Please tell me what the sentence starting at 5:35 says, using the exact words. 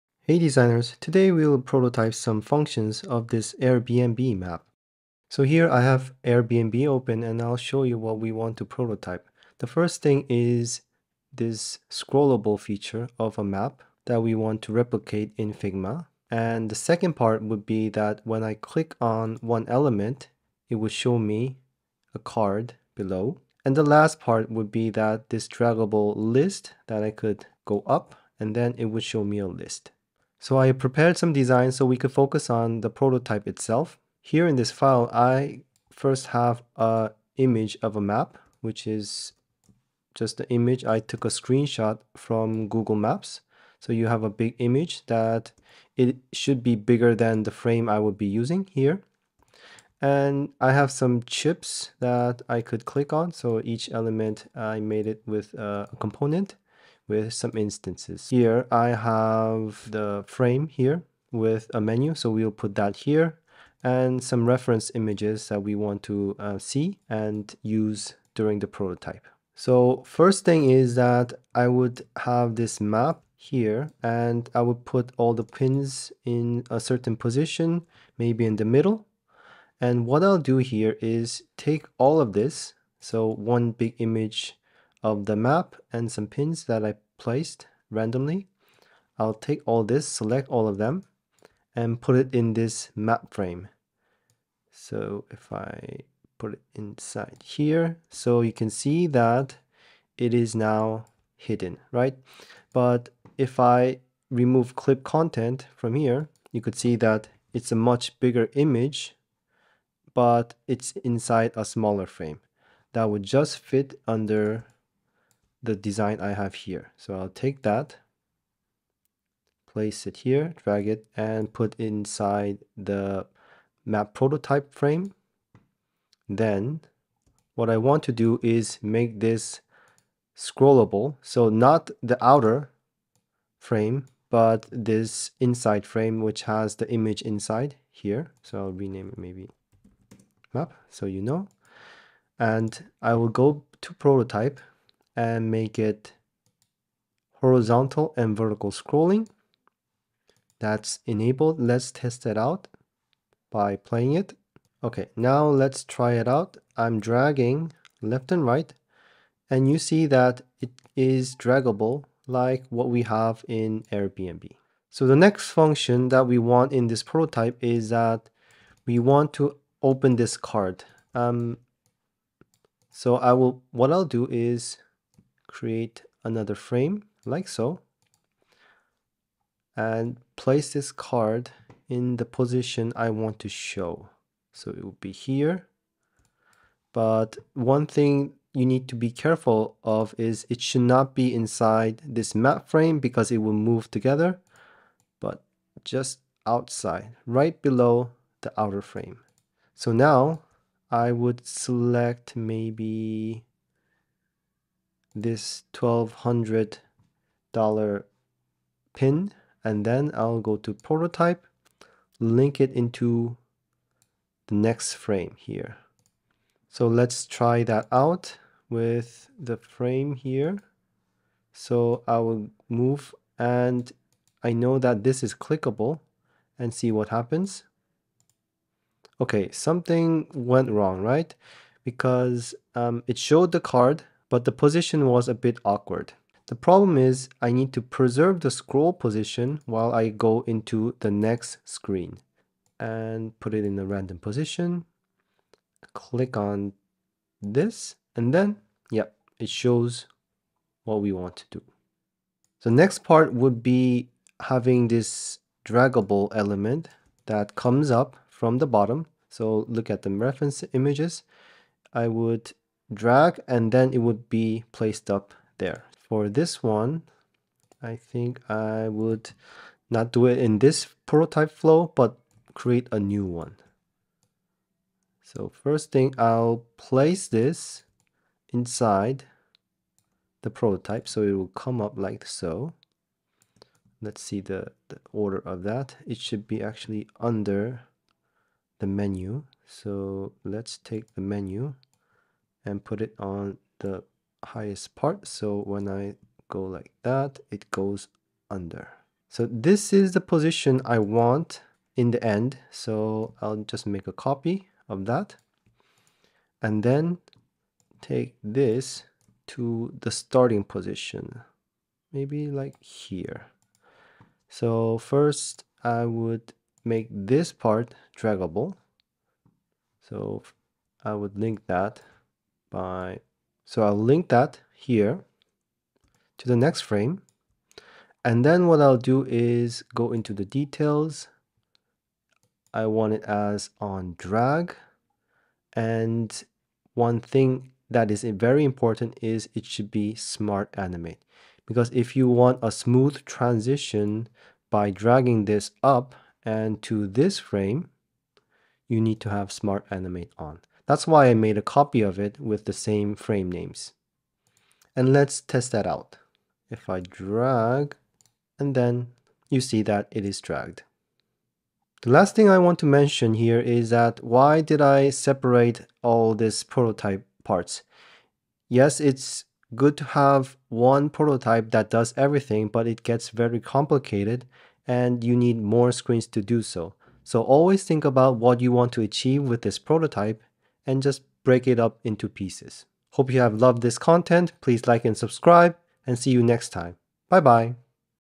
And one thing that is very important is it should be smart animate.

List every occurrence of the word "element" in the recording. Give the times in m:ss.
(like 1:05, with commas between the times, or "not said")
0:19, 0:53, 4:16.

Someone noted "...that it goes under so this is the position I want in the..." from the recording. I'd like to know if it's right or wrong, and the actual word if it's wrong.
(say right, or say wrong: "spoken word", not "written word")
right.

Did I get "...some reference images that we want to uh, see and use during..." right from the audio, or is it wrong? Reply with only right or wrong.
right.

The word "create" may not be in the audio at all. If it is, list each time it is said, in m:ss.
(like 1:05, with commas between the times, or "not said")
2:55, 4:32.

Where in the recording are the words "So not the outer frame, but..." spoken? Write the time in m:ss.
2:11.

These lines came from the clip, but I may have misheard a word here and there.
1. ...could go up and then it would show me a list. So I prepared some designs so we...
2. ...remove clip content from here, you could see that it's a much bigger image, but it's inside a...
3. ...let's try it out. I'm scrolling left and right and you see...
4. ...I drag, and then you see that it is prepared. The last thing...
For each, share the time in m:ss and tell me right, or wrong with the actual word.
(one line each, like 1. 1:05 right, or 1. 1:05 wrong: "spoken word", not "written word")
1. 0:27 right
2. 1:44 right
3. 2:35 wrong: "dragging", not "scrolling"
4. 5:56 wrong: "dragged", not "prepared".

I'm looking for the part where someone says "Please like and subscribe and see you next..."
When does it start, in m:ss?
6:24.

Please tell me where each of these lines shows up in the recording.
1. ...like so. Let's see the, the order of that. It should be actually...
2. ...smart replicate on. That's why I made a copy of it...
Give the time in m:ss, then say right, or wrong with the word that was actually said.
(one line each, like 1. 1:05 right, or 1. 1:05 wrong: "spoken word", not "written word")
1. 4:41 right
2. 5:49 wrong: "animate", not "replicate".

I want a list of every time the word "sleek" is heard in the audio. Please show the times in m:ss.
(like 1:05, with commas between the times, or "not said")
not said.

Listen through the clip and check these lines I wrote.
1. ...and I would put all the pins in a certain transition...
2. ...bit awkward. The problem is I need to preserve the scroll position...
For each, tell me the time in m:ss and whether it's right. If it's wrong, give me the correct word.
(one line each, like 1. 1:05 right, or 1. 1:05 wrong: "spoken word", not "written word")
1. 1:14 wrong: "position", not "transition"
2. 3:55 right.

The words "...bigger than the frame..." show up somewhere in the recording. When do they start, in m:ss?
0:46.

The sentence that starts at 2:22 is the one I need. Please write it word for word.
And I will go to prototype and make it horizontal and vertical scrolling.